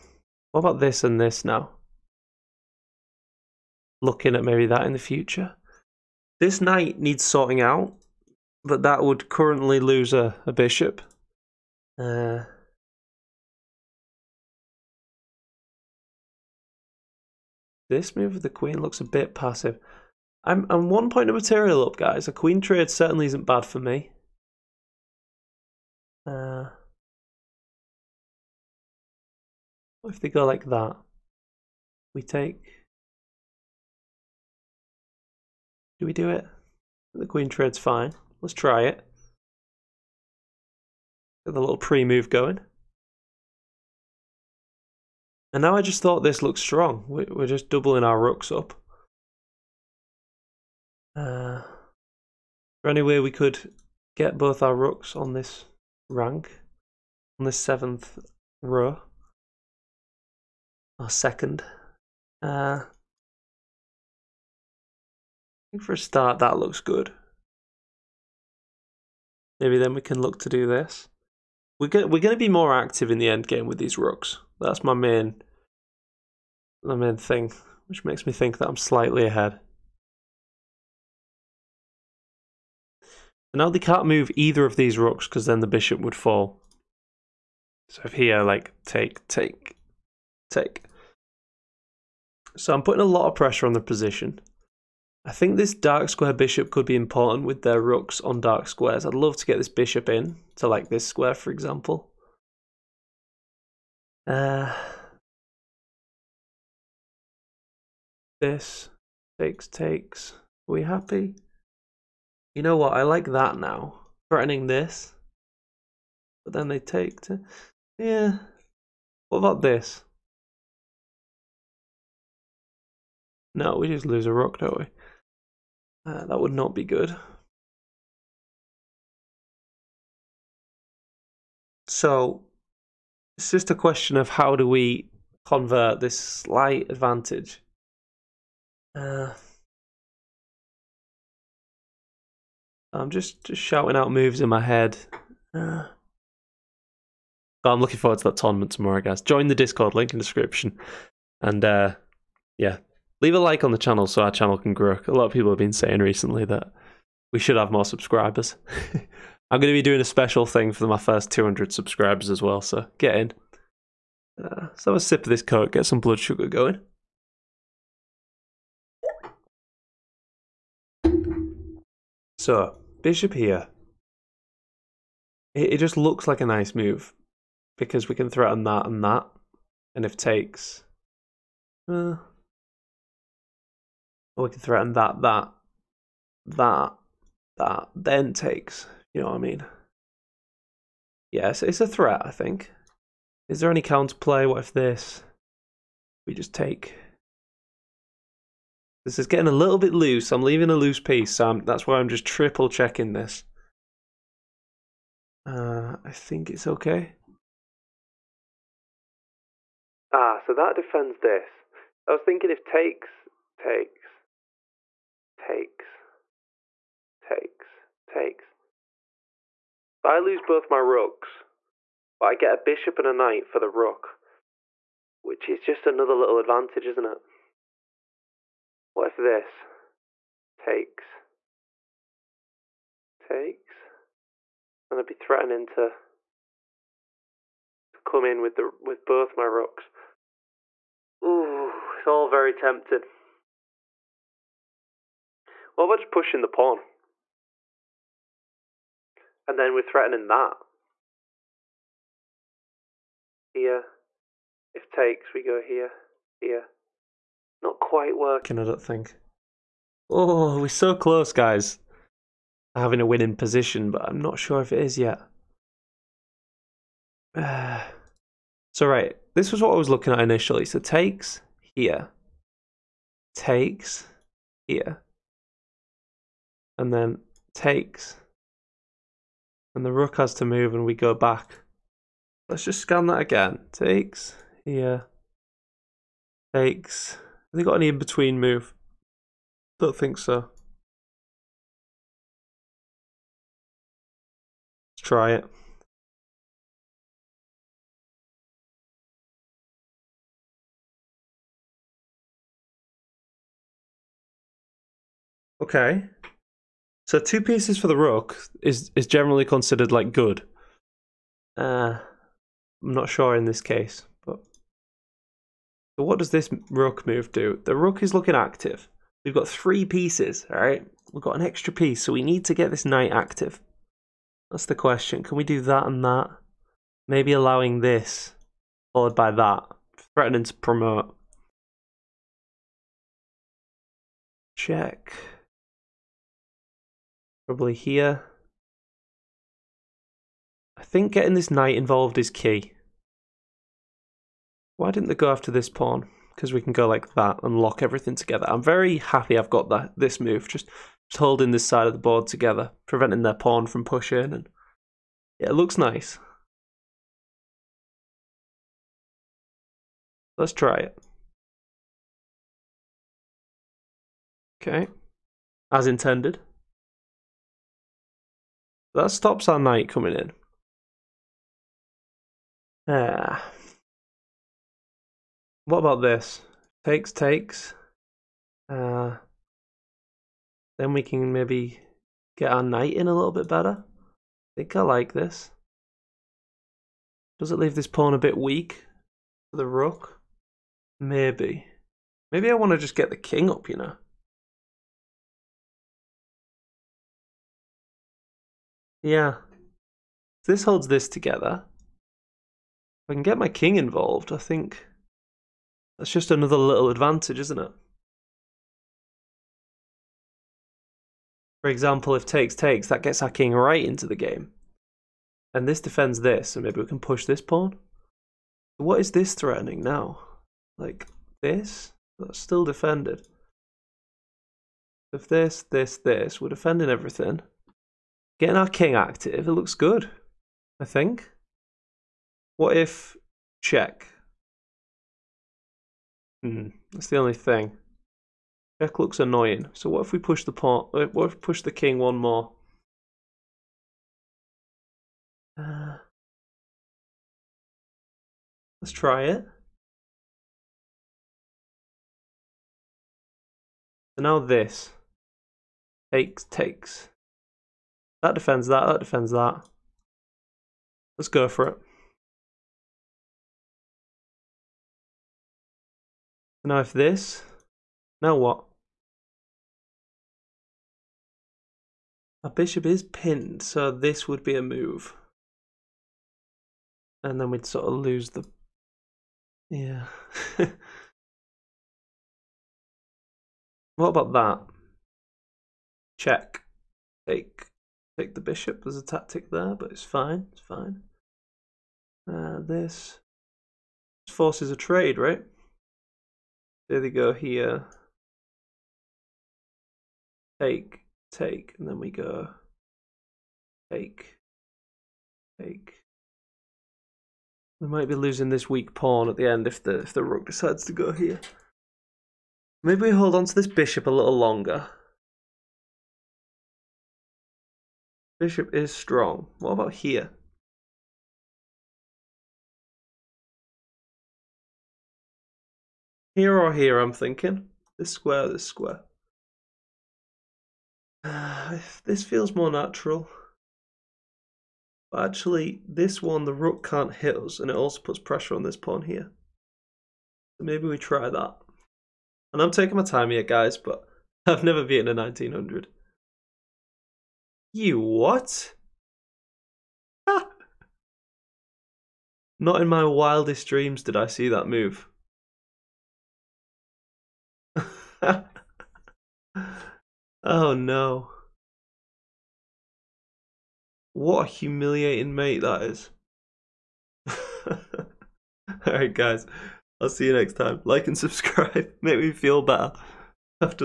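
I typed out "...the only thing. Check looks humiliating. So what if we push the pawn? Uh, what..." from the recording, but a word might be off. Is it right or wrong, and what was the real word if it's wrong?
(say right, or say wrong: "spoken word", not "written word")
wrong: "annoying", not "humiliating".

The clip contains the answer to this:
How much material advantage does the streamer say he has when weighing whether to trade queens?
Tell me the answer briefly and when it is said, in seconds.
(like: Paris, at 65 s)
1 point, at 20 s.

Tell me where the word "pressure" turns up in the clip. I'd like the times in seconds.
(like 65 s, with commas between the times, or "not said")
93 s, 538 s.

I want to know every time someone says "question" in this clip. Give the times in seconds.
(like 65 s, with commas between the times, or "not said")
133 s, 324 s.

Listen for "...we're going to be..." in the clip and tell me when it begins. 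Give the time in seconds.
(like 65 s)
72 s.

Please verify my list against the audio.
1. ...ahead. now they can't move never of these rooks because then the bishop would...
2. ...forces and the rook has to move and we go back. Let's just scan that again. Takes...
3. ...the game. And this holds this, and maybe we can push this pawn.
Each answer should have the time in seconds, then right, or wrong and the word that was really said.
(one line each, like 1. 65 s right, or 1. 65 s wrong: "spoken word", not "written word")
1. 79 s wrong: "either", not "never"
2. 277 s wrong: "takes", not "forces"
3. 414 s wrong: "defends", not "holds".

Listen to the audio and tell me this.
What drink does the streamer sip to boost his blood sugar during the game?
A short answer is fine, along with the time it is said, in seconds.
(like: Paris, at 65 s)
Coke, at 165 s.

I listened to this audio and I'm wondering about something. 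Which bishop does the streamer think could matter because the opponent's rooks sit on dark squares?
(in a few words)
dark square bishop.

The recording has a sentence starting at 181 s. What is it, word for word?
Uh, or we can threaten that, that, that, that, then takes.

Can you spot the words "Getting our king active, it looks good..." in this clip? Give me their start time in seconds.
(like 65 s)
428 s.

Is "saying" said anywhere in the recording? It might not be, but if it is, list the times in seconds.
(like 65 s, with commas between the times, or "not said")
155 s.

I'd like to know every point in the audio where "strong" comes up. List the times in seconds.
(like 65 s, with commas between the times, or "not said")
46 s, 518 s.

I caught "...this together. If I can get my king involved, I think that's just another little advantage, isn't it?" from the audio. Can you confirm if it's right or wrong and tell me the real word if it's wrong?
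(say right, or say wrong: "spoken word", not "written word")
right.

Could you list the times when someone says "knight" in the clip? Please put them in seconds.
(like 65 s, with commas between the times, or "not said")
6 s, 223 s, 322 s, 341 s, 369 s, 382 s.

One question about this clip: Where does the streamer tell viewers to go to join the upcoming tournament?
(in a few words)
Discord.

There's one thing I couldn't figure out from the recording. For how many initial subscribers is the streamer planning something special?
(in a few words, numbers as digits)
200.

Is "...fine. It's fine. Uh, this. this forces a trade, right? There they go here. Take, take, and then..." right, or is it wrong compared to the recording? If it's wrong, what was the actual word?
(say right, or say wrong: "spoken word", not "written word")
right.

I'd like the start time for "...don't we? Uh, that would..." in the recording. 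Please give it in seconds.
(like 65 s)
124 s.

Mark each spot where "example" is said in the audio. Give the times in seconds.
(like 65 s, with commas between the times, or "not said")
101 s, 411 s.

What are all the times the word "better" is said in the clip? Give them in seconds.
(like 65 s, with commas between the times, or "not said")
383 s, 572 s.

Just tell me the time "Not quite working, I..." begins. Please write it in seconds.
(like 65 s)
257 s.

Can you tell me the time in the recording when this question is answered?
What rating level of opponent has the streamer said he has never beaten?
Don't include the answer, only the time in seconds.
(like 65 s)
545 s.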